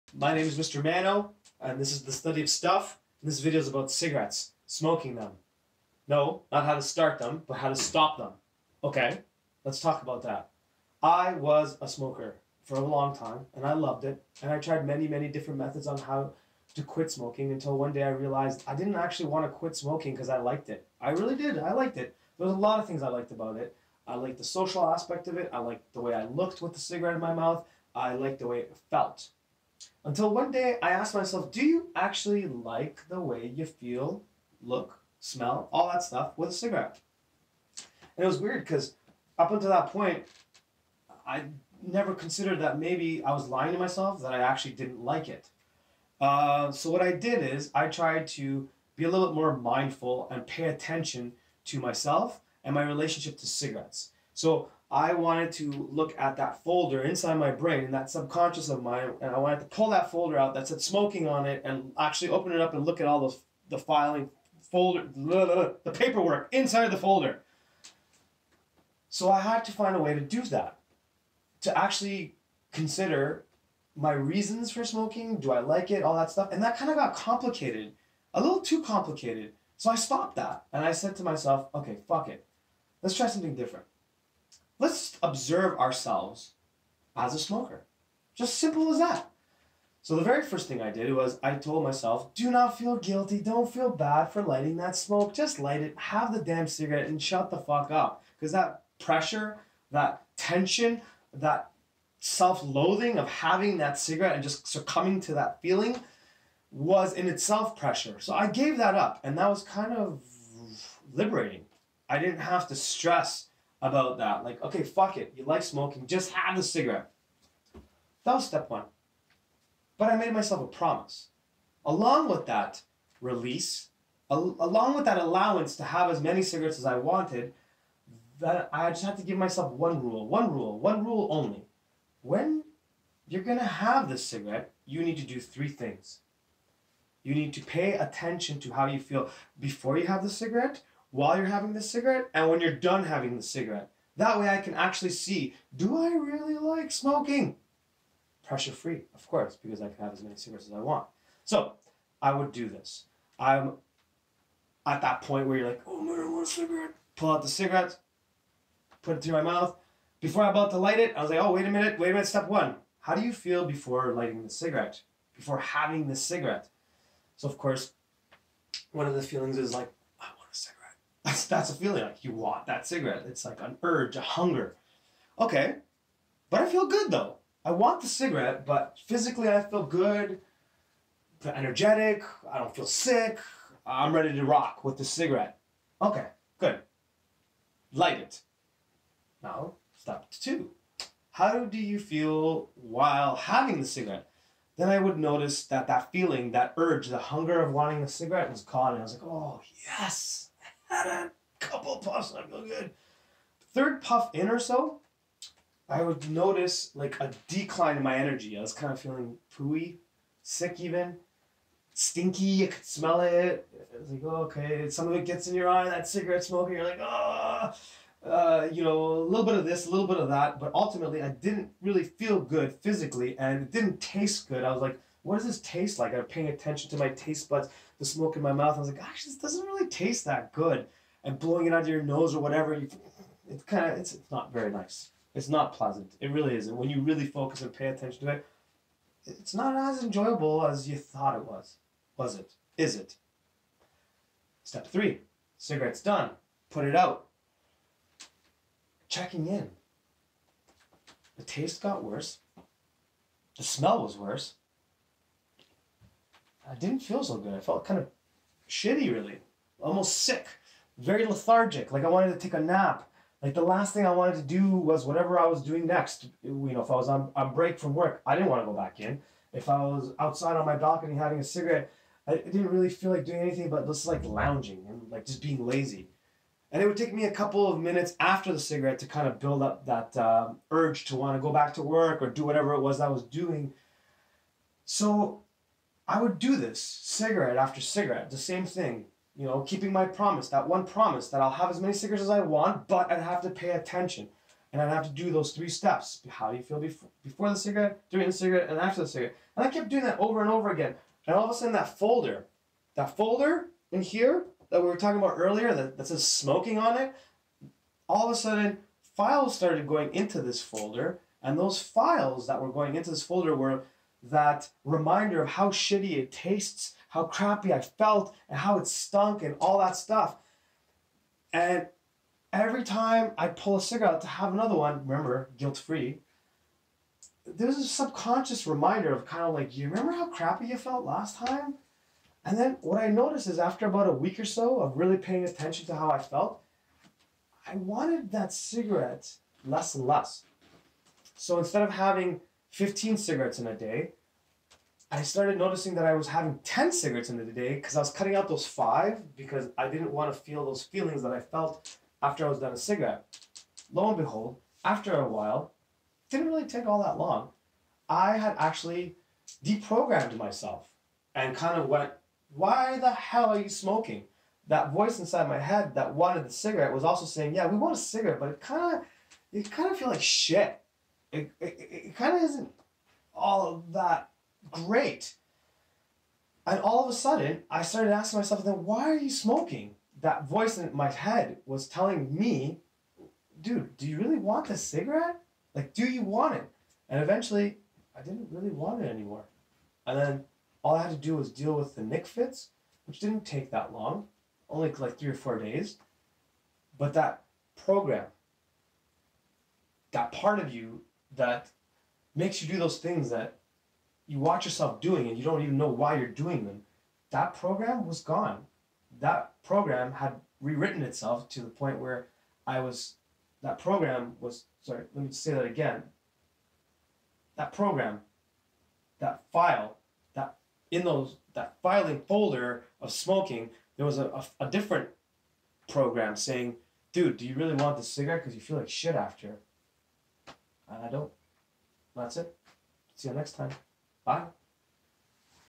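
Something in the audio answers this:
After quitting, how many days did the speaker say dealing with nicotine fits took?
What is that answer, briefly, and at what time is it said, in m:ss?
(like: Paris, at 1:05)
3 or 4 days, at 6:35.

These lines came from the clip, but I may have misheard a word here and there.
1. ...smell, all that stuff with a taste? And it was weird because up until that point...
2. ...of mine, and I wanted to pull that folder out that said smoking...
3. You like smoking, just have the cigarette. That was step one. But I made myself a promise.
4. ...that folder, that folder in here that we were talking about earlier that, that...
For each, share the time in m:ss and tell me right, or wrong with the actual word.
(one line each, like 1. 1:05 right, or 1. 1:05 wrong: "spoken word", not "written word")
1. 0:35 wrong: "cigarette", not "taste"
2. 0:58 right
3. 1:55 right
4. 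5:01 right.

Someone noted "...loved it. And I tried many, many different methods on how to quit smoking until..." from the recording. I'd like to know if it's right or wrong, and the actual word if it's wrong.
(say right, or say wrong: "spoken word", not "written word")
right.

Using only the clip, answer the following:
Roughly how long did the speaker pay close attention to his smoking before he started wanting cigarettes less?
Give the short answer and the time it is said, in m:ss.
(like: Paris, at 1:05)
about a week, at 5:33.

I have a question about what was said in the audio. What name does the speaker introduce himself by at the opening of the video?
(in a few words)
Mr. Mano.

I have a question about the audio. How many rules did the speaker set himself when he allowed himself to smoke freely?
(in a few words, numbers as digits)
1.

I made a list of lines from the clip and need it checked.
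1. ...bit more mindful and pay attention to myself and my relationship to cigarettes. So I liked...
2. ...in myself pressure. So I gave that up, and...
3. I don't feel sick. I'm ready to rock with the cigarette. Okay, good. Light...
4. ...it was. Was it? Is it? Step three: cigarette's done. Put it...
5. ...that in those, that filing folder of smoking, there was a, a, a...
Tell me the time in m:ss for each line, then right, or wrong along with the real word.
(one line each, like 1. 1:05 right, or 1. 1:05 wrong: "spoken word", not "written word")
1. 0:49 wrong: "wanted", not "liked"
2. 1:47 wrong: "itself", not "myself"
3. 3:02 right
4. 4:01 right
5. 7:00 right.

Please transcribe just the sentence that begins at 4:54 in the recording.
And I'd have to do those three steps.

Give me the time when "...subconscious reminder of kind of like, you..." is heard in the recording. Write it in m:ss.
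5:27.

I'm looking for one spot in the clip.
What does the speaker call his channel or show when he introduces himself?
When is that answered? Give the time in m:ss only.
0:02.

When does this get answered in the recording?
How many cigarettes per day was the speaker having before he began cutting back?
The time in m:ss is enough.
5:42.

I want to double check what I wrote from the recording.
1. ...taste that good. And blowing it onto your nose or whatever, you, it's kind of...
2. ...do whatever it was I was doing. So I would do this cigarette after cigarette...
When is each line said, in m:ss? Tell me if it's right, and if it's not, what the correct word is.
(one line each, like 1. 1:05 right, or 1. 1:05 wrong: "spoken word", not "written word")
1. 3:49 right
2. 4:42 right.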